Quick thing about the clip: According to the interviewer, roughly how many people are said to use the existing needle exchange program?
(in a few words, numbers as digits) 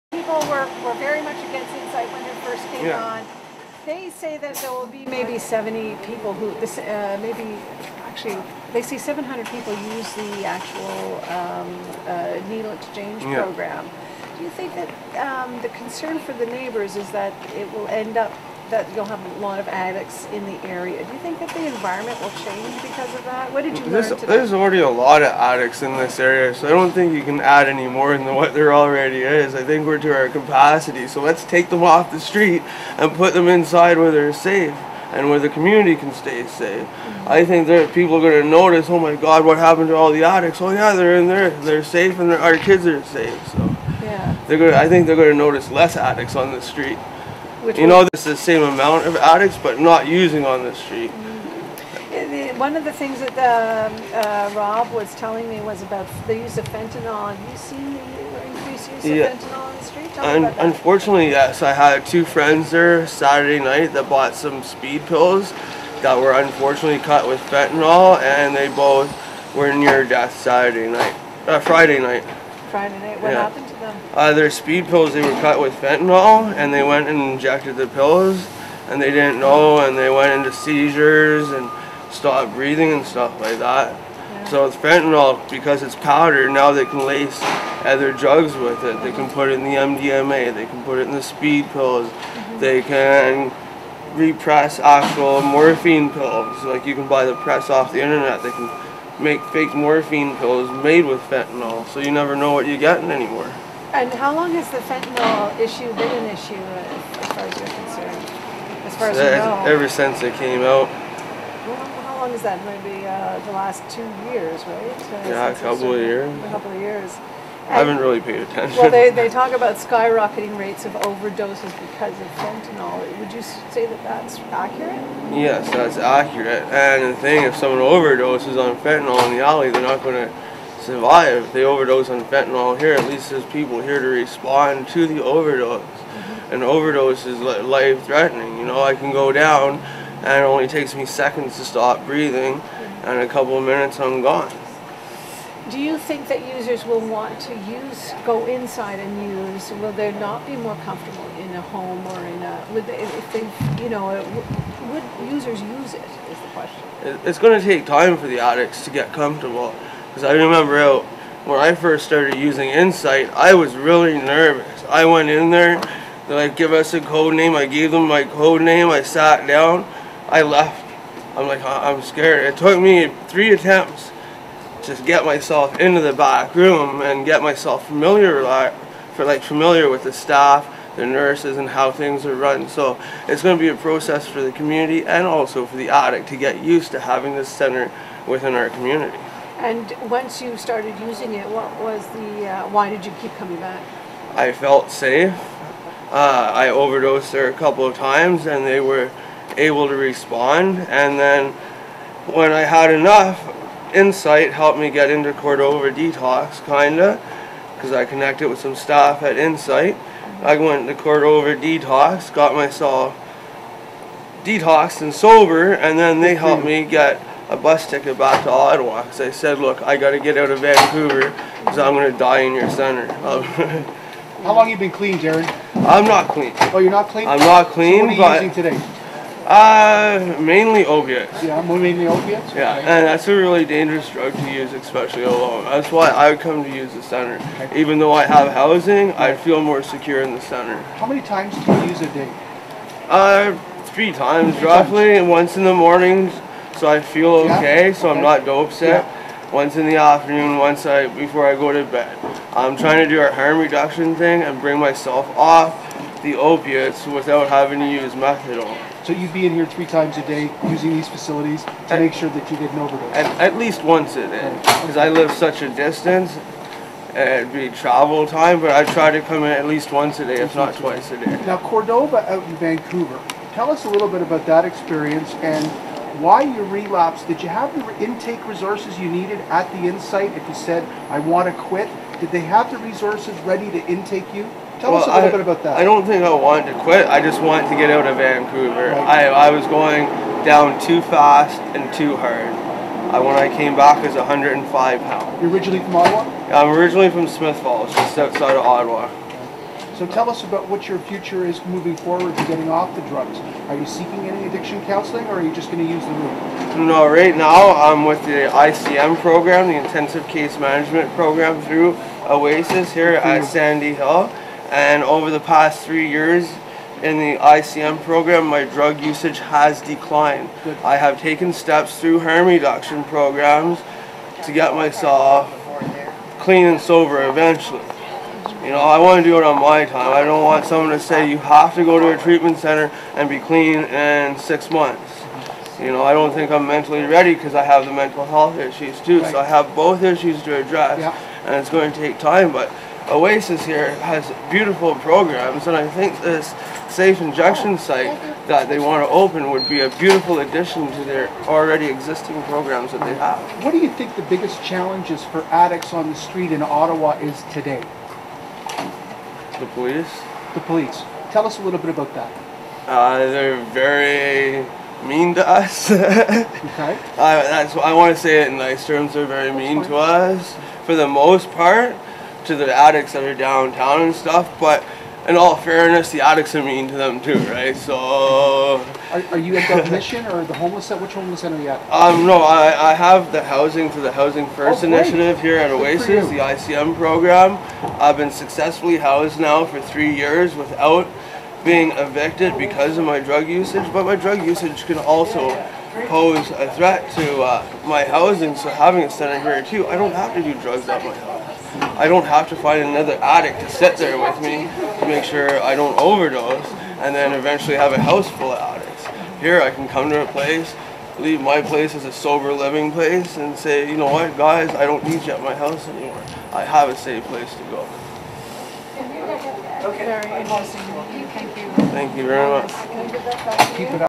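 700.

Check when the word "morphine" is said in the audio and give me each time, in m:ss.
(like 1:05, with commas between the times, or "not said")
1:35, 1:39.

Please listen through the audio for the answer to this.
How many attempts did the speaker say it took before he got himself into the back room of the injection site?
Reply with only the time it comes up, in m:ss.
2:53.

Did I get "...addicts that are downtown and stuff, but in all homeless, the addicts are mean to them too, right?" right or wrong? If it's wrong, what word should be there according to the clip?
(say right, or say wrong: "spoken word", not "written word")
wrong: "fairness", not "homeless".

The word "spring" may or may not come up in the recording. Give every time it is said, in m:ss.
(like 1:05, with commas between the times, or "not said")
not said.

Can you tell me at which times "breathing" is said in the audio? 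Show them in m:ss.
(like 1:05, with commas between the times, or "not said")
1:22, 2:22.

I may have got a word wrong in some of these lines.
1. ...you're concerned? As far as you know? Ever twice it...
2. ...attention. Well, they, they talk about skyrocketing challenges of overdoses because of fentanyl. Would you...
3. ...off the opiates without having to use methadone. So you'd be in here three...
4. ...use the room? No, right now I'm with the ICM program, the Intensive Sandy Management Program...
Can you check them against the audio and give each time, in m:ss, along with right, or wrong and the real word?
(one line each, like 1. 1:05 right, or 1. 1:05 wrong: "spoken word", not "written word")
1. 1:47 wrong: "since", not "twice"
2. 1:58 wrong: "rates", not "challenges"
3. 4:15 right
4. 5:05 wrong: "Case", not "Sandy".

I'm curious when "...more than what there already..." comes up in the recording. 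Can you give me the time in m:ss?
0:27.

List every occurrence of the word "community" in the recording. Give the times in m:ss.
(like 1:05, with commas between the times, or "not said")
0:35, 3:04, 3:08.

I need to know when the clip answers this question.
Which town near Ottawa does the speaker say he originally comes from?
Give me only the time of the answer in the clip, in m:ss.
4:57.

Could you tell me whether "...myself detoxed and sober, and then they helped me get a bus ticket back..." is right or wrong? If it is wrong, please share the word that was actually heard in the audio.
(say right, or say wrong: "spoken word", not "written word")
right.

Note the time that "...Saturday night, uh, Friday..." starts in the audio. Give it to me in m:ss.
1:10.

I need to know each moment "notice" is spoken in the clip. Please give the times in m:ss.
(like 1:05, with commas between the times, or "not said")
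0:38, 0:45.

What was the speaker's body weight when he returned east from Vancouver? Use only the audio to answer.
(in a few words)
105 pounds.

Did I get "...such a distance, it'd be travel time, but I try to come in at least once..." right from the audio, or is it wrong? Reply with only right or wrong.
right.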